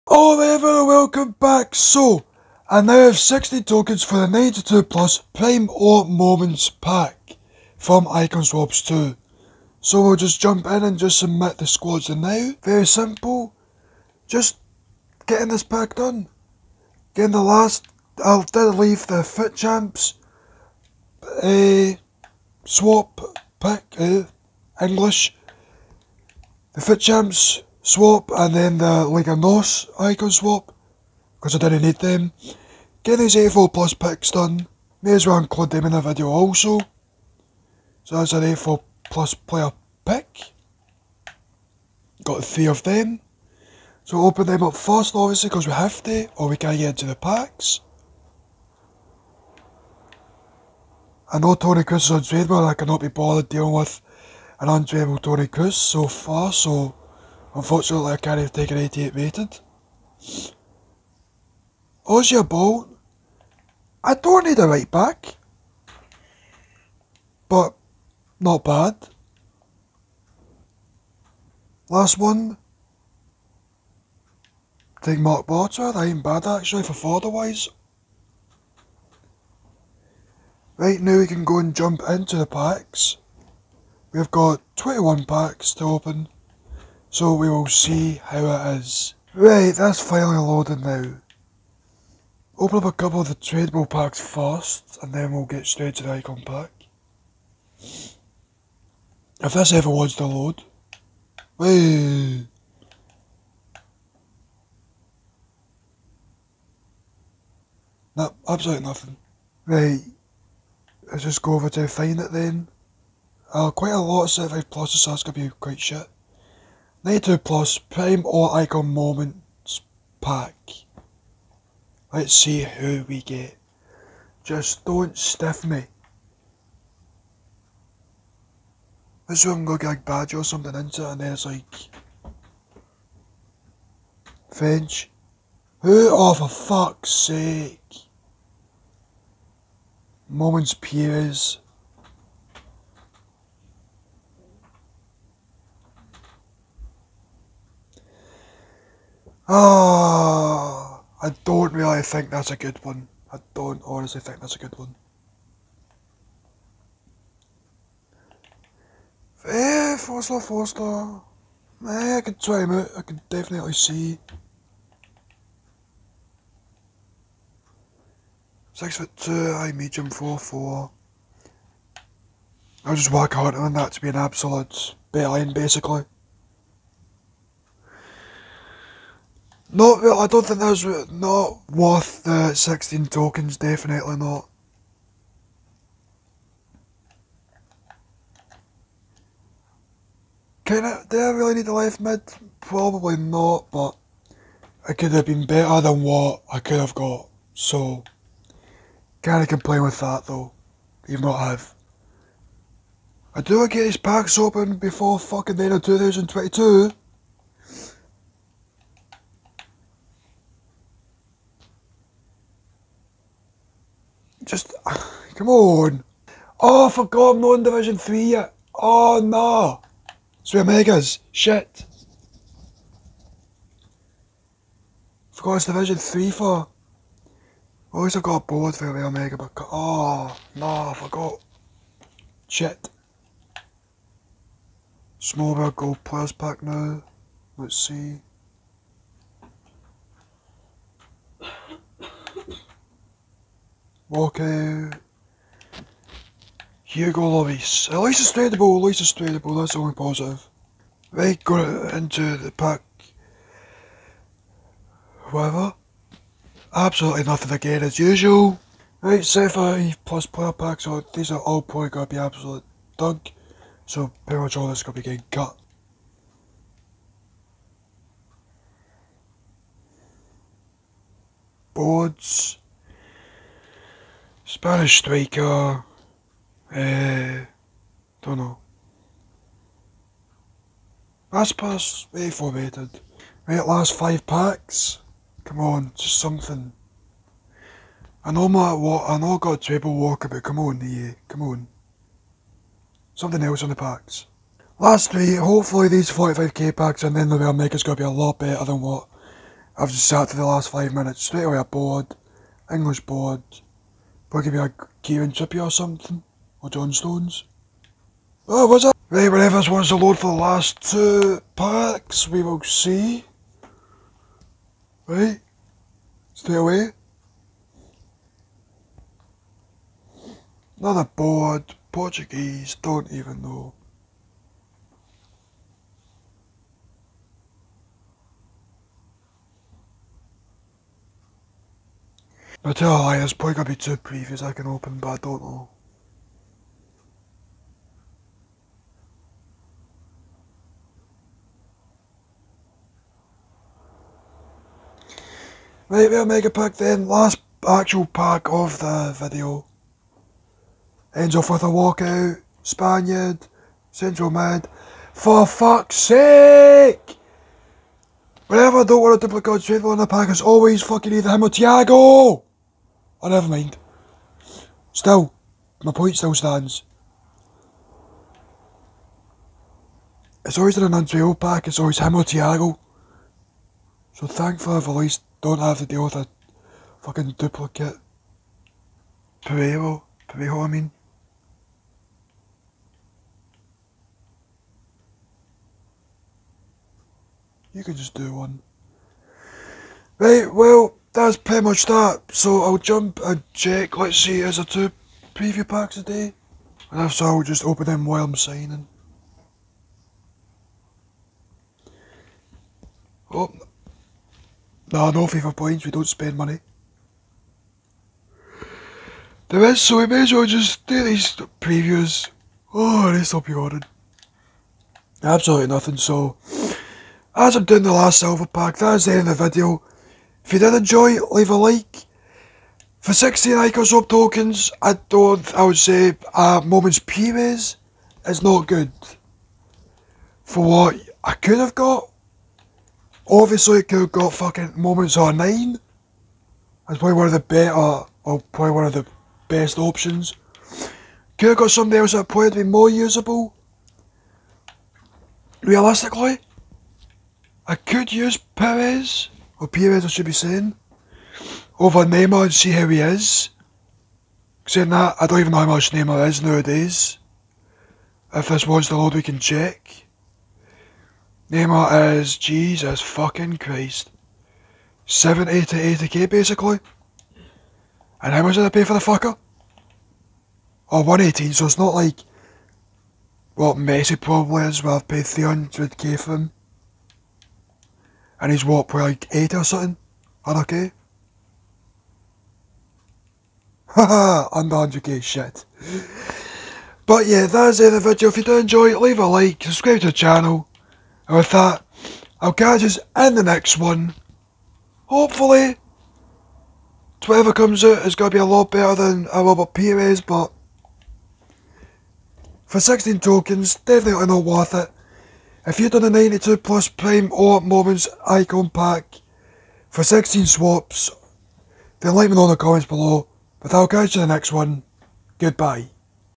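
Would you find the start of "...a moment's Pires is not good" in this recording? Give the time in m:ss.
7:06.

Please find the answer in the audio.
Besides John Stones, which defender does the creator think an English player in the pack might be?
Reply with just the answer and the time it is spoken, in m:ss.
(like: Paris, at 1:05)
Kieran Trippier, at 5:05.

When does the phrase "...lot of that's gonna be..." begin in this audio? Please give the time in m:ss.
1:53.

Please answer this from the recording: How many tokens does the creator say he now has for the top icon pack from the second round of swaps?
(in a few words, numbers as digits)
60.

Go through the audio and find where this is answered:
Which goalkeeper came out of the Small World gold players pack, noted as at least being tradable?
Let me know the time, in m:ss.
4:06.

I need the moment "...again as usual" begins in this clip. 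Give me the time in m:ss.
4:17.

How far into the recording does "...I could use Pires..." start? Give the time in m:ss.
7:27.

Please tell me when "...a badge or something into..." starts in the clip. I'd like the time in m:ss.
2:09.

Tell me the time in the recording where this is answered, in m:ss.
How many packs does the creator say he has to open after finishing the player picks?
1:24.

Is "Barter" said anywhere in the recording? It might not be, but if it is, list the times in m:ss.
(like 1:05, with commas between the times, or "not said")
1:15.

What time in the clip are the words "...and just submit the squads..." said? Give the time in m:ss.
0:10.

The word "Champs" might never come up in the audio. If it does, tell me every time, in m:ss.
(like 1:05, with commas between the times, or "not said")
0:19, 0:26.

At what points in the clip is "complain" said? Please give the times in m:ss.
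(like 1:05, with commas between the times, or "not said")
3:19.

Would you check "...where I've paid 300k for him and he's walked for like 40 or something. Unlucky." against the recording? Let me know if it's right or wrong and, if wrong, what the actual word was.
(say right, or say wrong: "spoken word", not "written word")
wrong: "80", not "40".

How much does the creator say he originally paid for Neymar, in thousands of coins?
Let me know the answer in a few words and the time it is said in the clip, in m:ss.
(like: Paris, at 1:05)
118, at 7:51.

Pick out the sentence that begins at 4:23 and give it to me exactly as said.
So pretty much all this is going to be getting cut.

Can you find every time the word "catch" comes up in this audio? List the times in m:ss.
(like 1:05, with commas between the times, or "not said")
8:12, 8:33.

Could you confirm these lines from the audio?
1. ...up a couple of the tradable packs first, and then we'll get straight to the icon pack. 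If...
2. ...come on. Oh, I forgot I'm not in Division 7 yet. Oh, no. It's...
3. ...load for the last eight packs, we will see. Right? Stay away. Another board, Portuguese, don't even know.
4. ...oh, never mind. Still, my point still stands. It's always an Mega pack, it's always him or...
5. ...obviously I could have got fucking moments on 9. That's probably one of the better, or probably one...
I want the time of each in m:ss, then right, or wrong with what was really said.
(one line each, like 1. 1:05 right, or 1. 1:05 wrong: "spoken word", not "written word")
1. 1:32 right
2. 3:35 wrong: "3", not "7"
3. 5:09 wrong: "two", not "eight"
4. 6:03 wrong: "Anuncio", not "Mega"
5. 7:13 right.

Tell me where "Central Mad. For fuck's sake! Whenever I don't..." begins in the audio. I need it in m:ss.
5:53.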